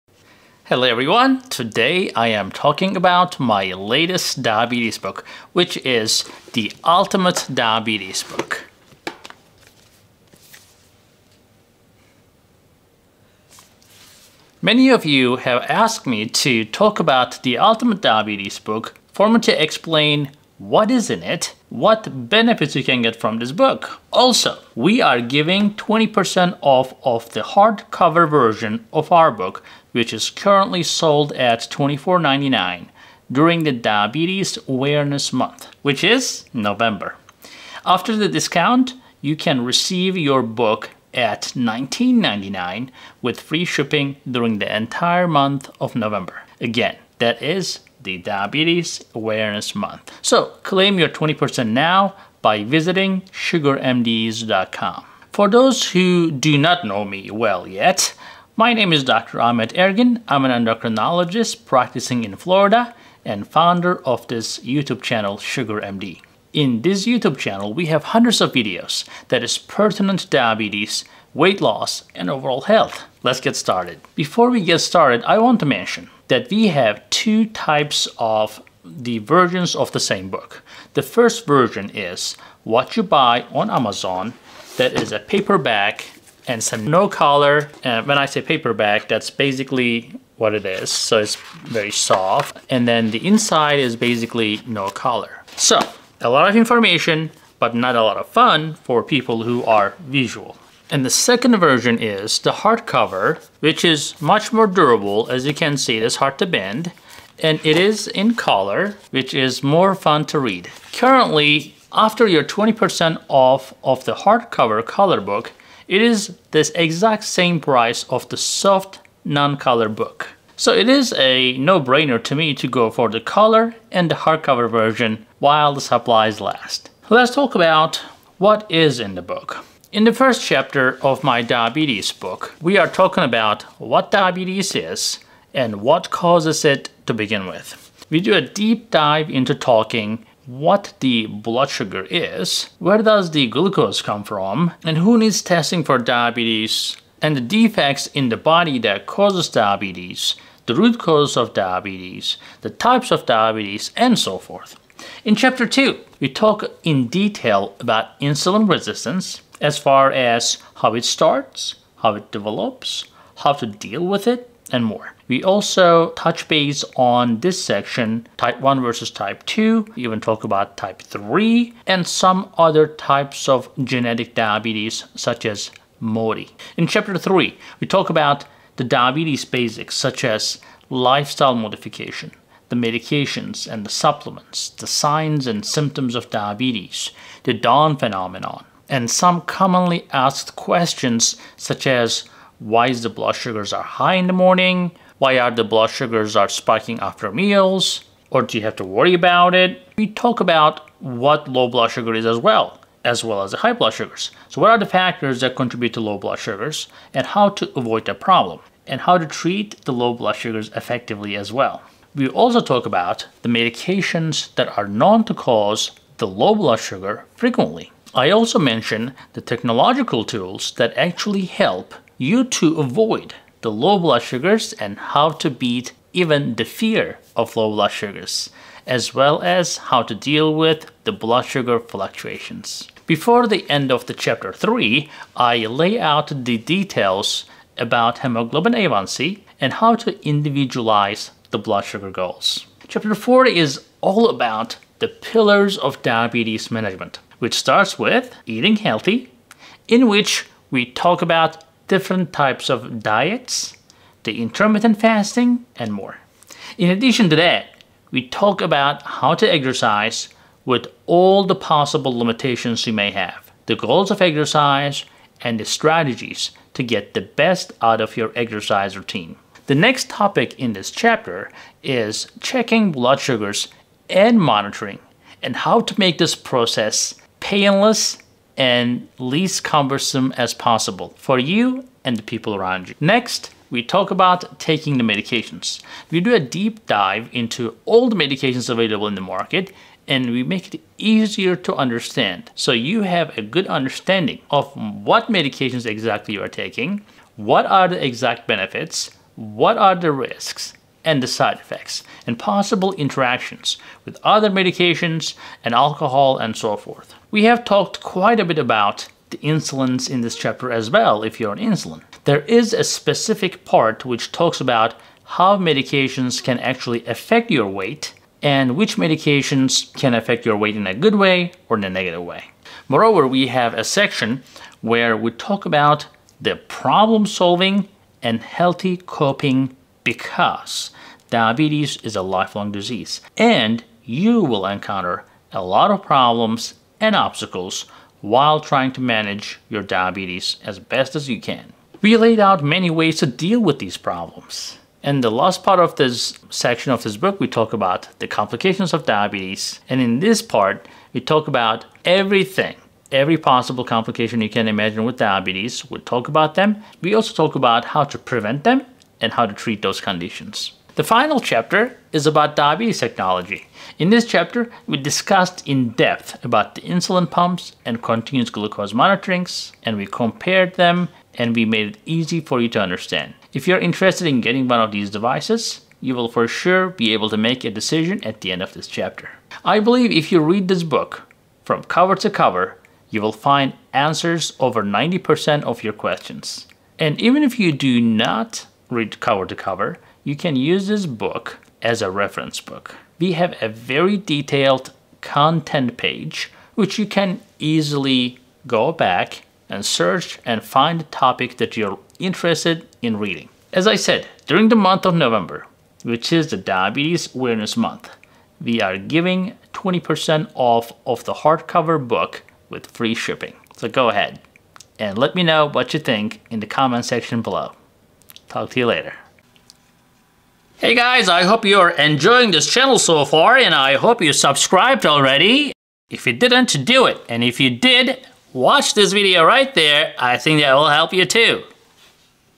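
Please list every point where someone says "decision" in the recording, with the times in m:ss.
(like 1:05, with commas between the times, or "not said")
6:17.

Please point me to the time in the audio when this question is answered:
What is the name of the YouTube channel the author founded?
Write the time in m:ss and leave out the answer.
1:05.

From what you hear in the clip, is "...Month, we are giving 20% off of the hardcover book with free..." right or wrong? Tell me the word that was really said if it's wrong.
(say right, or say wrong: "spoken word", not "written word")
right.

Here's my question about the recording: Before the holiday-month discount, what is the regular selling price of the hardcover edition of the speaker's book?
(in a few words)
$24.99.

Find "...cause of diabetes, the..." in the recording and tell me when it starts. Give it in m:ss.
2:30.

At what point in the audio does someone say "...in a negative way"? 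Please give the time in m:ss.
5:21.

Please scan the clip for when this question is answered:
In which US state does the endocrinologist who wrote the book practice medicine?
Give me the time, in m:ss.
1:02.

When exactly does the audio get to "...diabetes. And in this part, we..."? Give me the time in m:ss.
5:49.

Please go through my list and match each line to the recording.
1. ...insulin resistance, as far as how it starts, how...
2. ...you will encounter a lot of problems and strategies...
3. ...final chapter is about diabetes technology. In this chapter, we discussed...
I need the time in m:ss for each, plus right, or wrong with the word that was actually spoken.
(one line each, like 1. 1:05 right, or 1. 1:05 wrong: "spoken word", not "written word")
1. 2:38 right
2. 5:34 wrong: "obstacles", not "strategies"
3. 6:01 right.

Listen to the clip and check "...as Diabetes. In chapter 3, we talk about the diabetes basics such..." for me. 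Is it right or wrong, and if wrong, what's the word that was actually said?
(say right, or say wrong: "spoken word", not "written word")
wrong: "MODY", not "Diabetes".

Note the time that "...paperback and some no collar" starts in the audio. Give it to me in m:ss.
1:25.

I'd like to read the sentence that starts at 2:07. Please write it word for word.
Let's talk about what is in the book.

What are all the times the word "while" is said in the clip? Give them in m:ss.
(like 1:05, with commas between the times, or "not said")
2:05, 5:38.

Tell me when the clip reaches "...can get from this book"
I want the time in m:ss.
0:22.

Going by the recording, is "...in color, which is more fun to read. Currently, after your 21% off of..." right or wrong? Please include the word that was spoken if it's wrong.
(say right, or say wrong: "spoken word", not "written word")
wrong: "20", not "21".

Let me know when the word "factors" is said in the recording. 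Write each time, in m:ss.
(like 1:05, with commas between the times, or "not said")
3:24.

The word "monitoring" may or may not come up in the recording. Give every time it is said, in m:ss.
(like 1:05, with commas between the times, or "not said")
4:34, 6:08.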